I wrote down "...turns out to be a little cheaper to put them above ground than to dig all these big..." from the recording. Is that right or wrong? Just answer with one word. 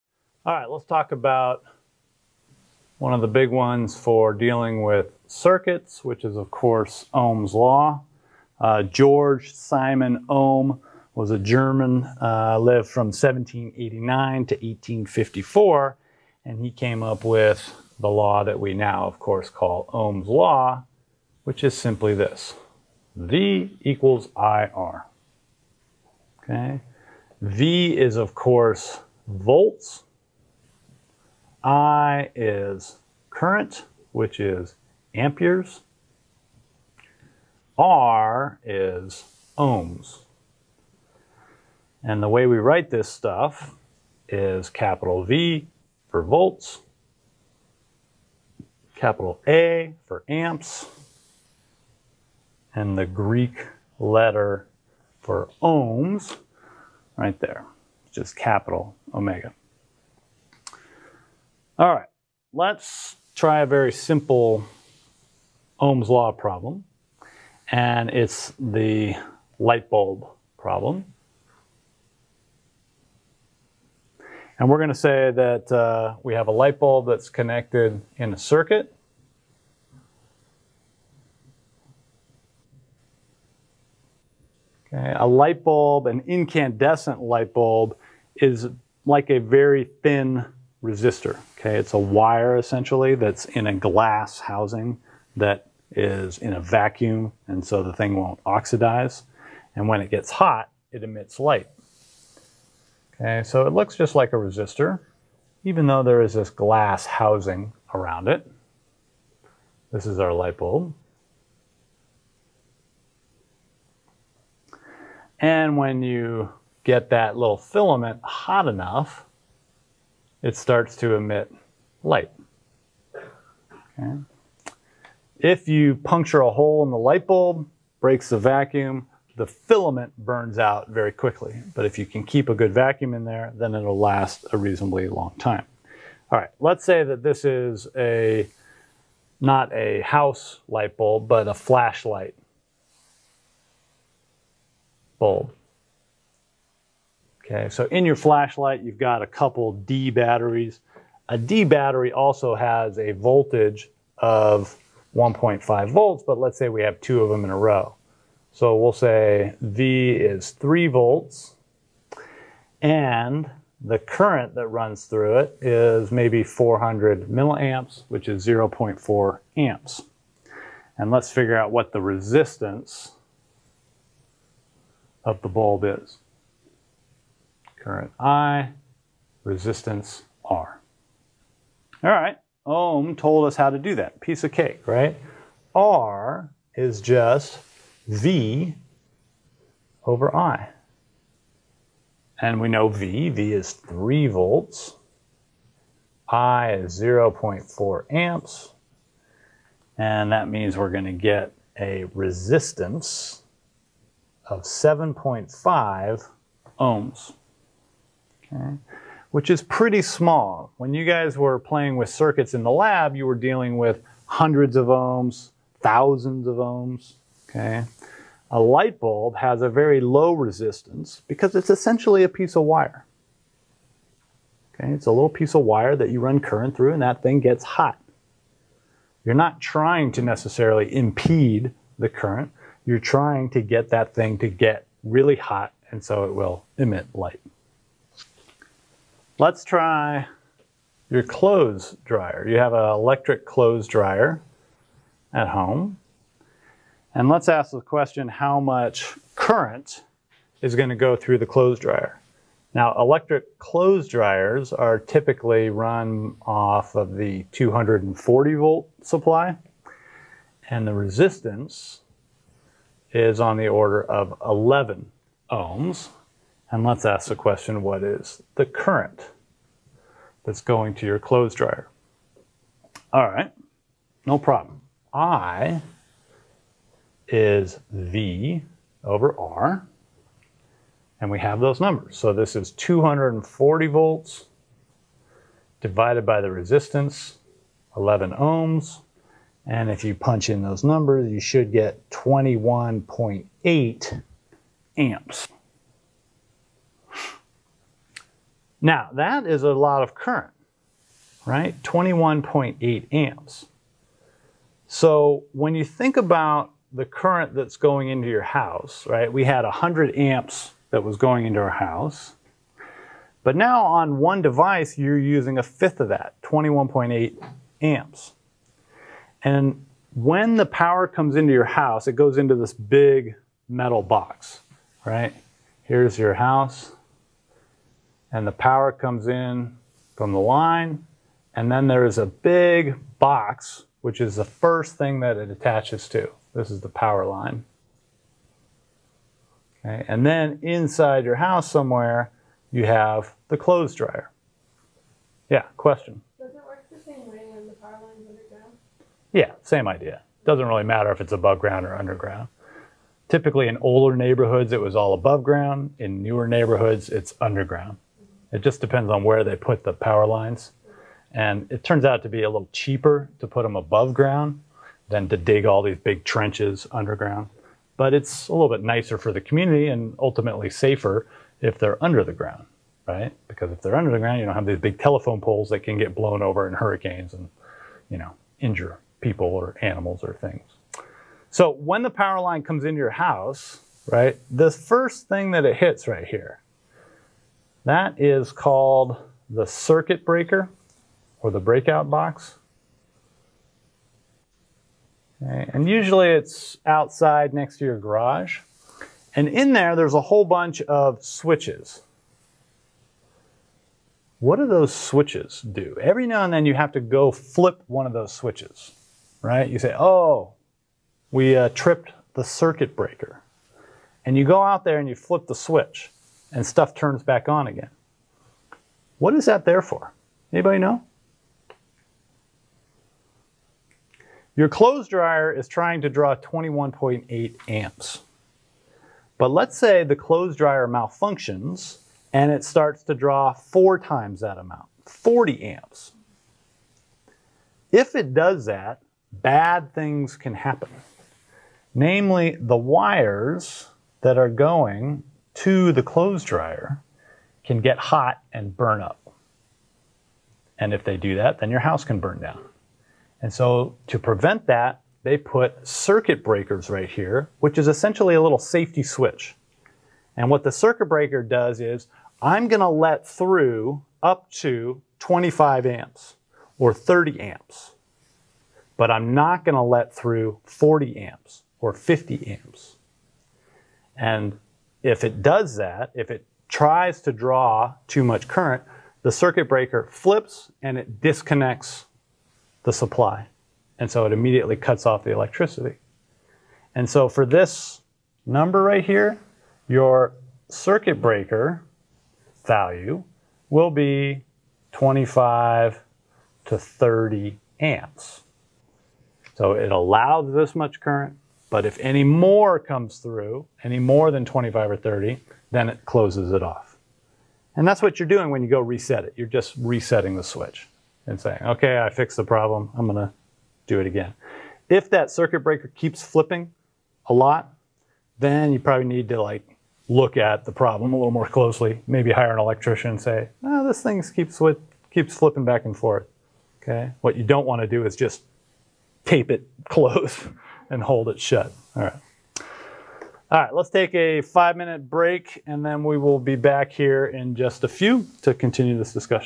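right.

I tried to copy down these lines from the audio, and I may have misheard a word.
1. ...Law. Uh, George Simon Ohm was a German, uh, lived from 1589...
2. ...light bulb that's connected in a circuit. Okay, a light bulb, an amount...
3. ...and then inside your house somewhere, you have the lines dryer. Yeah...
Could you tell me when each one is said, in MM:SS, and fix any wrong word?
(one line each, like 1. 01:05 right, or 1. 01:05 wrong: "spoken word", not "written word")
1. 00:07 wrong: "1789", not "1589"
2. 01:16 wrong: "incandescent", not "amount"
3. 05:40 wrong: "clothes", not "lines".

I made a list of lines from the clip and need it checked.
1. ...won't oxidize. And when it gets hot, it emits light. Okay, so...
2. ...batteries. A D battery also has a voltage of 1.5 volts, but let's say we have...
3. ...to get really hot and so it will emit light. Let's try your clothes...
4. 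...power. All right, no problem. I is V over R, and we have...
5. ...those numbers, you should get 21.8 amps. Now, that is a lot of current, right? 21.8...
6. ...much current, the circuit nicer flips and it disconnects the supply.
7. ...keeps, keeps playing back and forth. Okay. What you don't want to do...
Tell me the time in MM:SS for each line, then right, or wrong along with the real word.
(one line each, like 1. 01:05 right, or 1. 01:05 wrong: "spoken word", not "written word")
1. 01:38 right
2. 02:30 right
3. 03:54 right
4. 04:31 wrong: "dryer", not "power"
5. 04:50 right
6. 07:58 wrong: "breaker", not "nicer"
7. 08:44 wrong: "flipping", not "playing".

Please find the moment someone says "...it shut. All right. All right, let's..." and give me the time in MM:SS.
08:51.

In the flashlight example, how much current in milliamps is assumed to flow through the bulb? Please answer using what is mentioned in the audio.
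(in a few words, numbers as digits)
400 milliamps.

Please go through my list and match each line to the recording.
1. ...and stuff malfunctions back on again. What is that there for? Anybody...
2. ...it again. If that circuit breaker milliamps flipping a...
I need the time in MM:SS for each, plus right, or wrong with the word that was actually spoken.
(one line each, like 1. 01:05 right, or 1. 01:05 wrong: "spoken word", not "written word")
1. 06:56 wrong: "turns", not "malfunctions"
2. 08:34 wrong: "keeps", not "milliamps".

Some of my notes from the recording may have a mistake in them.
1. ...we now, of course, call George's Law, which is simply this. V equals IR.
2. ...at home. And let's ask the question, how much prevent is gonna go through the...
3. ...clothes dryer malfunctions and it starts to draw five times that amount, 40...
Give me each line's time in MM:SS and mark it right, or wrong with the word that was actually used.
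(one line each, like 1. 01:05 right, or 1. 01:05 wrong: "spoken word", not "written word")
1. 00:18 wrong: "Ohm", not "George"
2. 04:05 wrong: "current", not "prevent"
3. 07:10 wrong: "four", not "five".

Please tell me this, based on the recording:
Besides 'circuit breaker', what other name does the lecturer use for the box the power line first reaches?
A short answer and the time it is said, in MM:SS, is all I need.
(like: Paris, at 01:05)
breakout box, at 06:31.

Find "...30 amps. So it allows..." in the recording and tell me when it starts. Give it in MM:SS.
08:16.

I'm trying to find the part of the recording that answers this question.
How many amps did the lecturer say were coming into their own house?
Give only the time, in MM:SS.
05:09.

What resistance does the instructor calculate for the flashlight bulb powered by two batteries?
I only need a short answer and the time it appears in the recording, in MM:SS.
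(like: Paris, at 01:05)
7.5 ohms, at 03:24.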